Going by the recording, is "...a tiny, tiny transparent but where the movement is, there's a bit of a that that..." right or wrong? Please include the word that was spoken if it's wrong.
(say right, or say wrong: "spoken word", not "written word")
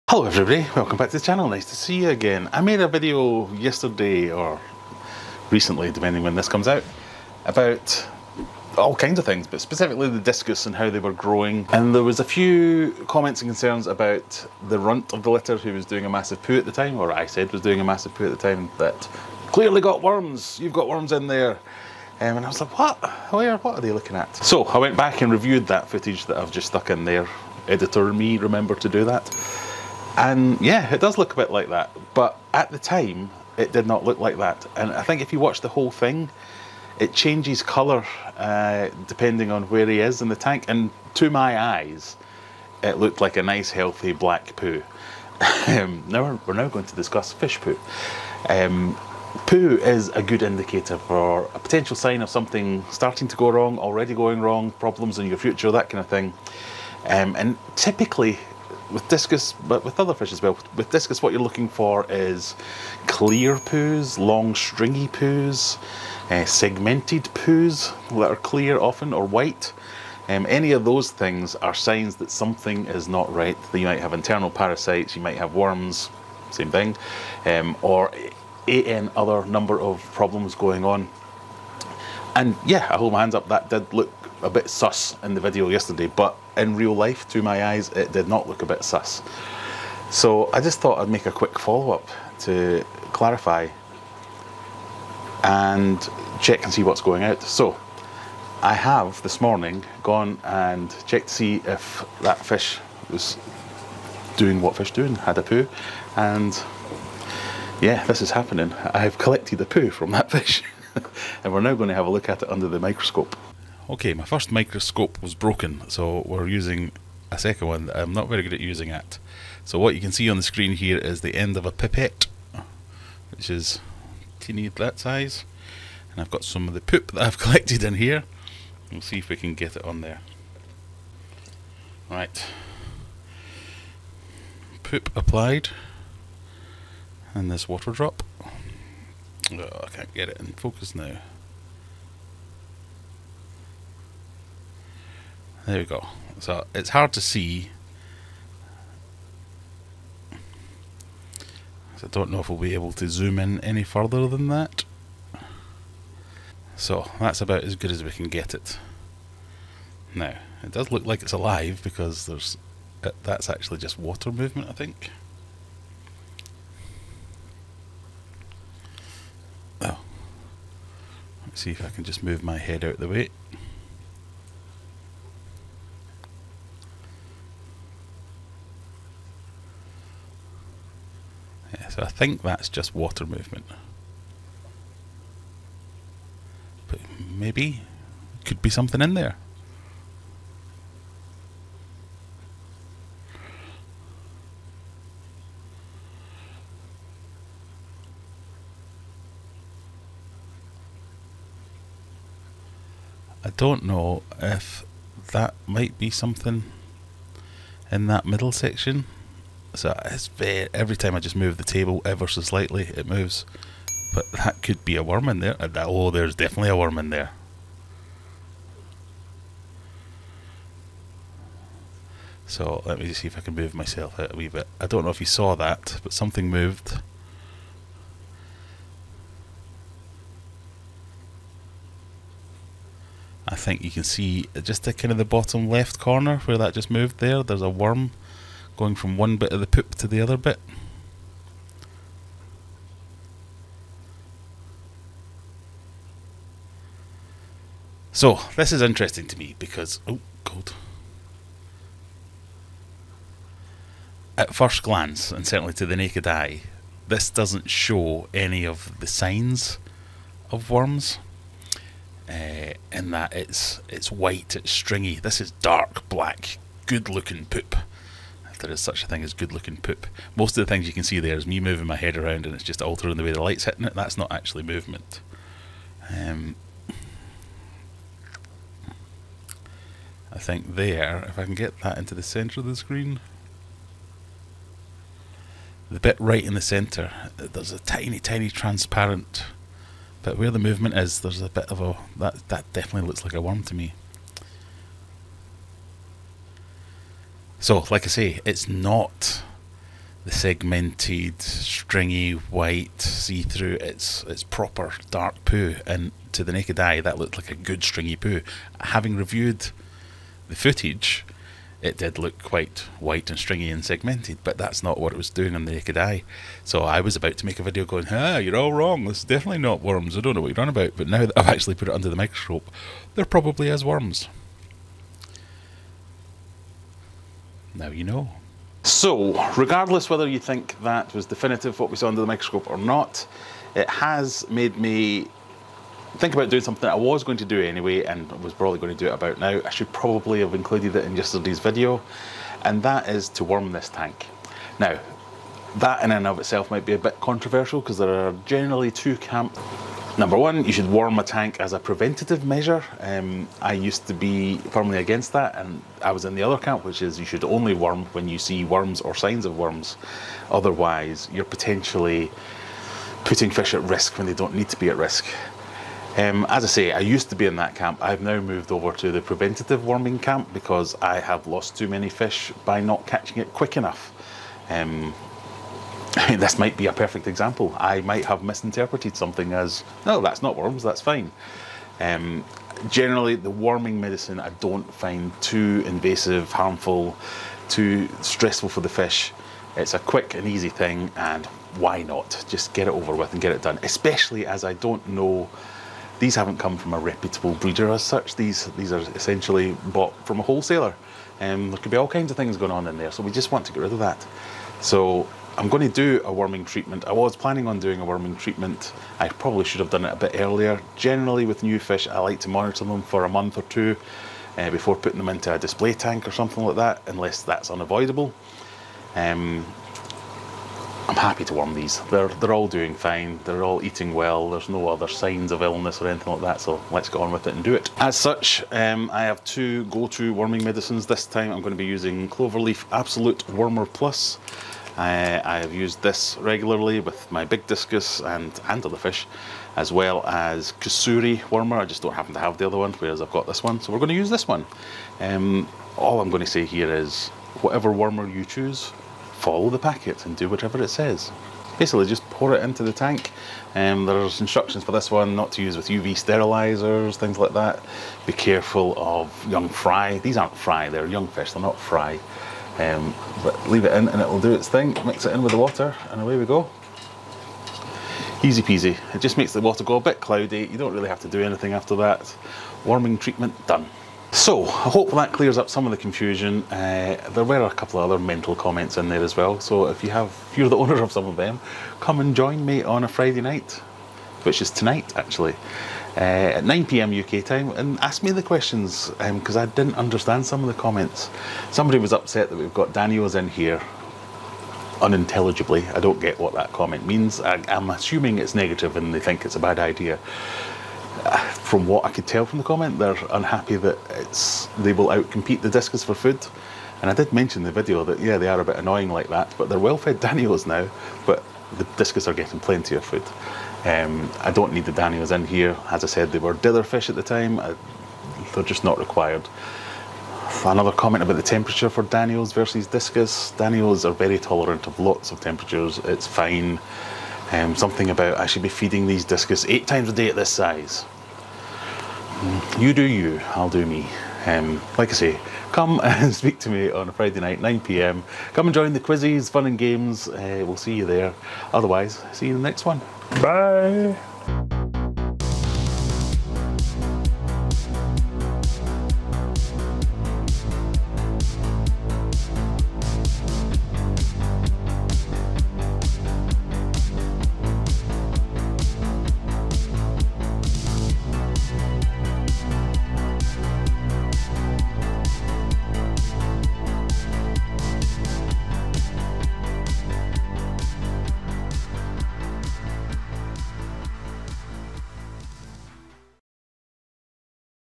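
right.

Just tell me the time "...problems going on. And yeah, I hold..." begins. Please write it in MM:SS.
01:20.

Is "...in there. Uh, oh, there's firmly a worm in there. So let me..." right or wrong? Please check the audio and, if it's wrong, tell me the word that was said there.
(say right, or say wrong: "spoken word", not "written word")
wrong: "definitely", not "firmly".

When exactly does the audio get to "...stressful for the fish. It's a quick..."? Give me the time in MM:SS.
06:28.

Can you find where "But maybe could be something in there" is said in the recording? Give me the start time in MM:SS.
03:06.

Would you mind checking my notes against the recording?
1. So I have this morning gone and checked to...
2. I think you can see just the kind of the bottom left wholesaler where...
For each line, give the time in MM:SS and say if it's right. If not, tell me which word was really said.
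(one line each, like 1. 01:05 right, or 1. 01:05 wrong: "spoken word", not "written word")
1. 01:37 right
2. 03:53 wrong: "corner", not "wholesaler".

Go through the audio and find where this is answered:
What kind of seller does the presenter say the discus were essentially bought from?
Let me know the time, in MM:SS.
06:40.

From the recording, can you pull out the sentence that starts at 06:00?
Otherwise, you're potentially putting fish at risk when they don't need to be at risk.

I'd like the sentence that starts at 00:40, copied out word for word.
And to my eyes, it looked like a nice, healthy black poo.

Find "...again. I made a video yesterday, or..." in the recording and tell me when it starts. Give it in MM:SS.
00:02.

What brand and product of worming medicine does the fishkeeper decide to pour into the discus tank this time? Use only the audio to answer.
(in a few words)
Cloverleaf Absolute Wormer Plus.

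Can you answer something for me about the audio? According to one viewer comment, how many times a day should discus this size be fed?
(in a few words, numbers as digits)
8.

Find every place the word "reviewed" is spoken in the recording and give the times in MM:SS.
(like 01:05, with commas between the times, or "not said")
00:25, 05:09.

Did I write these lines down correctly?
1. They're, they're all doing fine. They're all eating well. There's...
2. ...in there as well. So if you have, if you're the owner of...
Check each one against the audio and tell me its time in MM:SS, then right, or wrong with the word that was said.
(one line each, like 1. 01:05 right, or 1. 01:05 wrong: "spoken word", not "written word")
1. 07:02 right
2. 07:58 right.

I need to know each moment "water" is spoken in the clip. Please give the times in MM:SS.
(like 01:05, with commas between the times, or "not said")
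02:17, 02:43, 03:02, 07:45, 07:49.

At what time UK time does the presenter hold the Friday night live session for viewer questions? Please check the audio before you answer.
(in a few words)
9 p.m.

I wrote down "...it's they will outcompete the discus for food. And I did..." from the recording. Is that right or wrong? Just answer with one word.
right.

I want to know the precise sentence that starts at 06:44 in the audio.
So I'm going to do a worming treatment.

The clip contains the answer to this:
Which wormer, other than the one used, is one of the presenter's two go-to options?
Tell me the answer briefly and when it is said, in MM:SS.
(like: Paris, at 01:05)
Kusuri wormer, at 07:20.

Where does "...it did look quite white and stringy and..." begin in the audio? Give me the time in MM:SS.
05:11.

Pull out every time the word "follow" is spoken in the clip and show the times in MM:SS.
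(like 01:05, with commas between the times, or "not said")
01:31, 07:29.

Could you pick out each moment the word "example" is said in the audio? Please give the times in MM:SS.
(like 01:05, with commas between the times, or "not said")
06:17.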